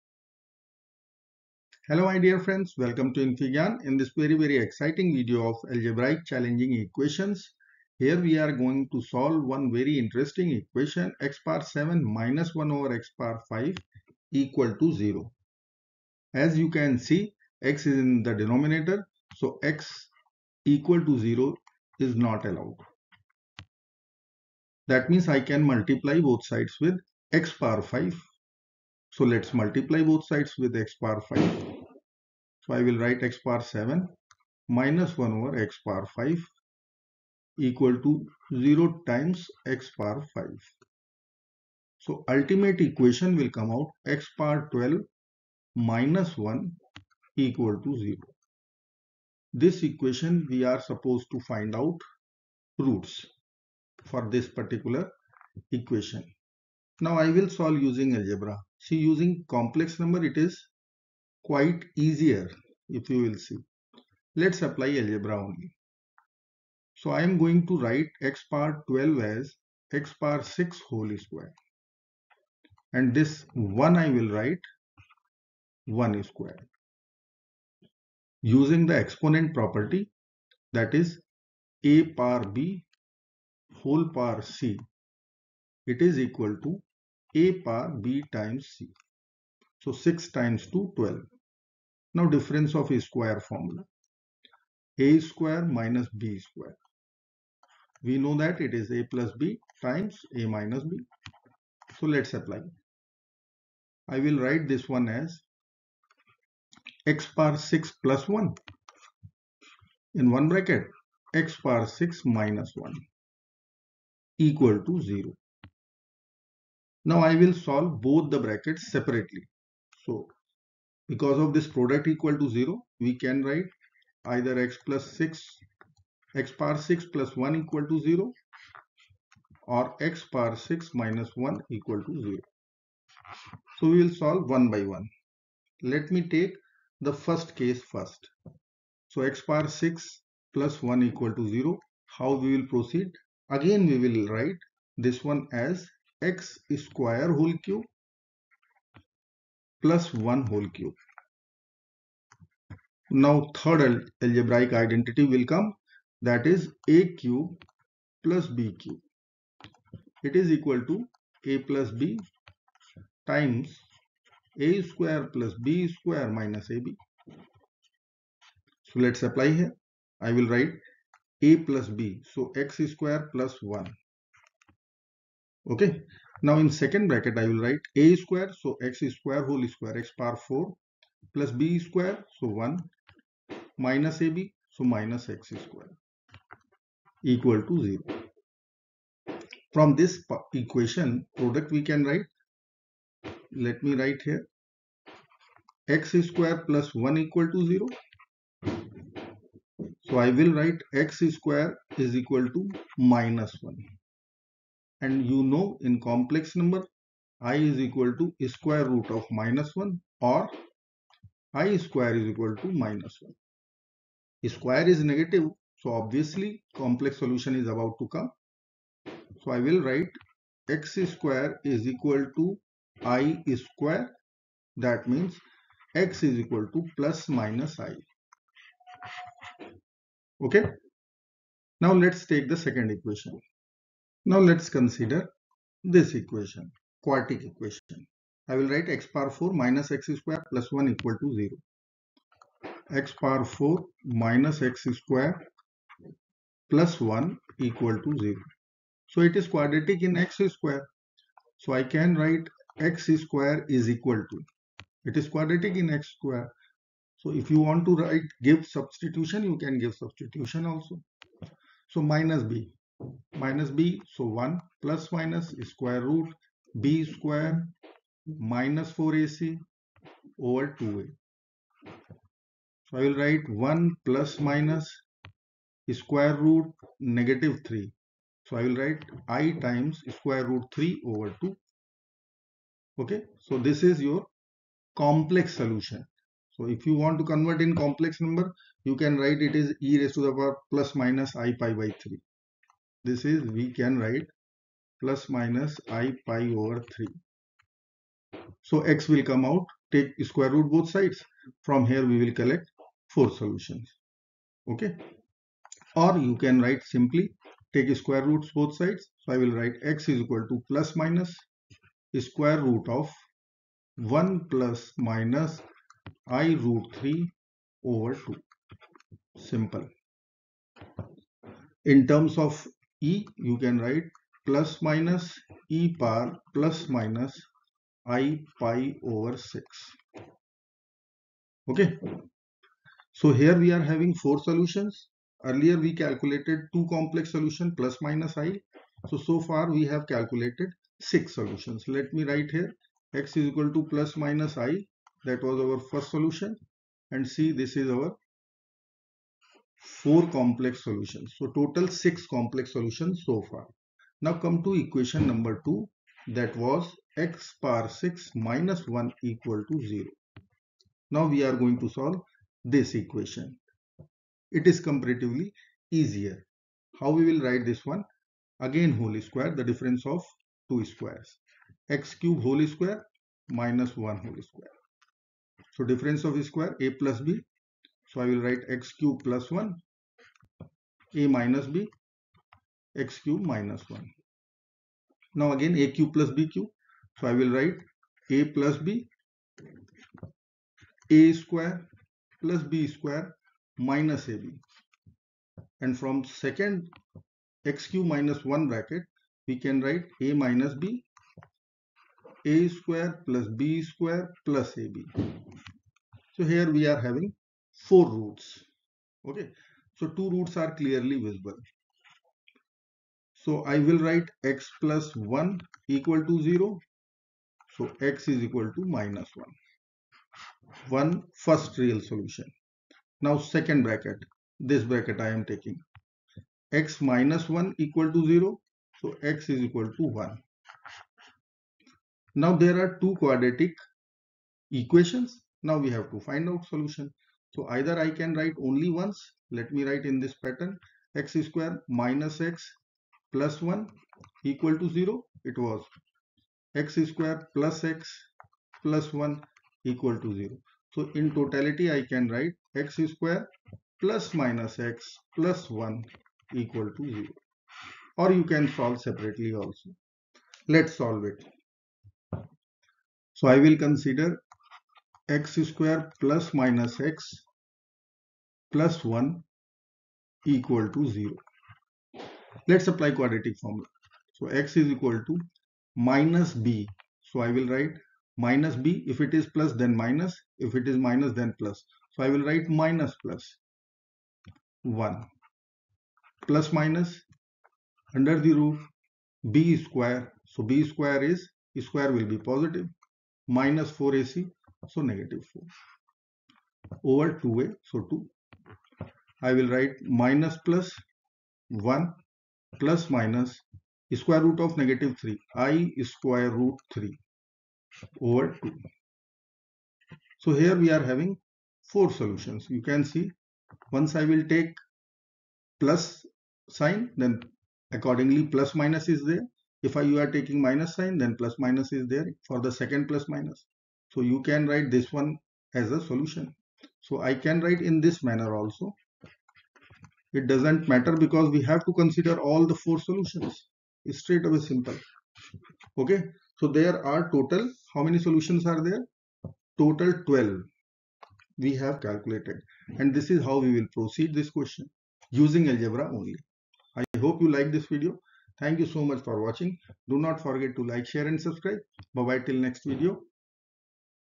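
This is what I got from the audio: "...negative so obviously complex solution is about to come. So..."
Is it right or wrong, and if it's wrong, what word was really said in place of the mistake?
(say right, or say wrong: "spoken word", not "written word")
right.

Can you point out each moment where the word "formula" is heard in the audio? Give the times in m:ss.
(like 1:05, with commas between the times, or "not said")
1:33, 7:53.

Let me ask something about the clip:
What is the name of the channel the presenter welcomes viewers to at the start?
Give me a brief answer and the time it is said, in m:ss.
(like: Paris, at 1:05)
infyGyan, at 0:03.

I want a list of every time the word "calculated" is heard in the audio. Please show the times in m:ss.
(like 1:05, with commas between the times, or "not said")
5:35, 5:40, 9:02.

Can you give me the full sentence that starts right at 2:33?
Now third algebraic identity will come that is a cube plus b cube.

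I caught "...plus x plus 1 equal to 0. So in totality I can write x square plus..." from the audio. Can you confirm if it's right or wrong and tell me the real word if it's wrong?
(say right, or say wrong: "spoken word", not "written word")
right.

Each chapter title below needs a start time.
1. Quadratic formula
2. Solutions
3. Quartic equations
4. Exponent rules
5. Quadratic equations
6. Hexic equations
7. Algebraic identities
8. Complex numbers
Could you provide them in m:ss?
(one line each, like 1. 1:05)
1. 7:56
2. 9:05
3. 4:12
4. 1:21
5. 7:37
6. 5:58
7. 2:35
8. 3:27.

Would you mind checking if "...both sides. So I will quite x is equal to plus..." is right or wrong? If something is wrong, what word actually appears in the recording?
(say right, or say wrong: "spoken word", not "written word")
wrong: "write", not "quite".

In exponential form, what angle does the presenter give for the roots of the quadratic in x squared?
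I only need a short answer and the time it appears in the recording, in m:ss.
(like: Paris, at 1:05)
plus or minus pi/3, at 4:54.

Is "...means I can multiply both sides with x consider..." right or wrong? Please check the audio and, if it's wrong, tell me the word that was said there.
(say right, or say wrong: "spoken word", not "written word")
wrong: "power", not "consider".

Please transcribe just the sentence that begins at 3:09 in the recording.
From this equation, product we can write, let me write here, x square plus 1 equal to 0.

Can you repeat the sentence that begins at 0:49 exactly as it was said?
This equation we are supposed to find out roots for this particular equation.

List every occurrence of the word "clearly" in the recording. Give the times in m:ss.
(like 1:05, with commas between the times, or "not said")
6:50.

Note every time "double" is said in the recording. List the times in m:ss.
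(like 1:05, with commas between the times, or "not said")
not said.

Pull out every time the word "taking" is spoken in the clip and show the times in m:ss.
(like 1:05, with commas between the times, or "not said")
7:05, 8:40.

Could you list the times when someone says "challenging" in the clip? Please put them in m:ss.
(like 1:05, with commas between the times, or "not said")
0:06.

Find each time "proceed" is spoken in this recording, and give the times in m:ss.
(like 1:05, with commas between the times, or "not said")
2:22, 9:03.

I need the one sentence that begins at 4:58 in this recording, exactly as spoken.
So x will come out, take square root both sides.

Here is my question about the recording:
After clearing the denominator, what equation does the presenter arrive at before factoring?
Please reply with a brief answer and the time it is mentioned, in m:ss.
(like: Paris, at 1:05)
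x^12 - 1 = 0, at 0:44.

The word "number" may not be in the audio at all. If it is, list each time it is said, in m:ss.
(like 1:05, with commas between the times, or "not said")
0:59, 3:26, 4:48, 5:55.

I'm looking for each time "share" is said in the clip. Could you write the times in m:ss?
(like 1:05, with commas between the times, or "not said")
9:11.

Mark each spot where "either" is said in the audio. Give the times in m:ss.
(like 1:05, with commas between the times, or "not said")
2:04, 7:17.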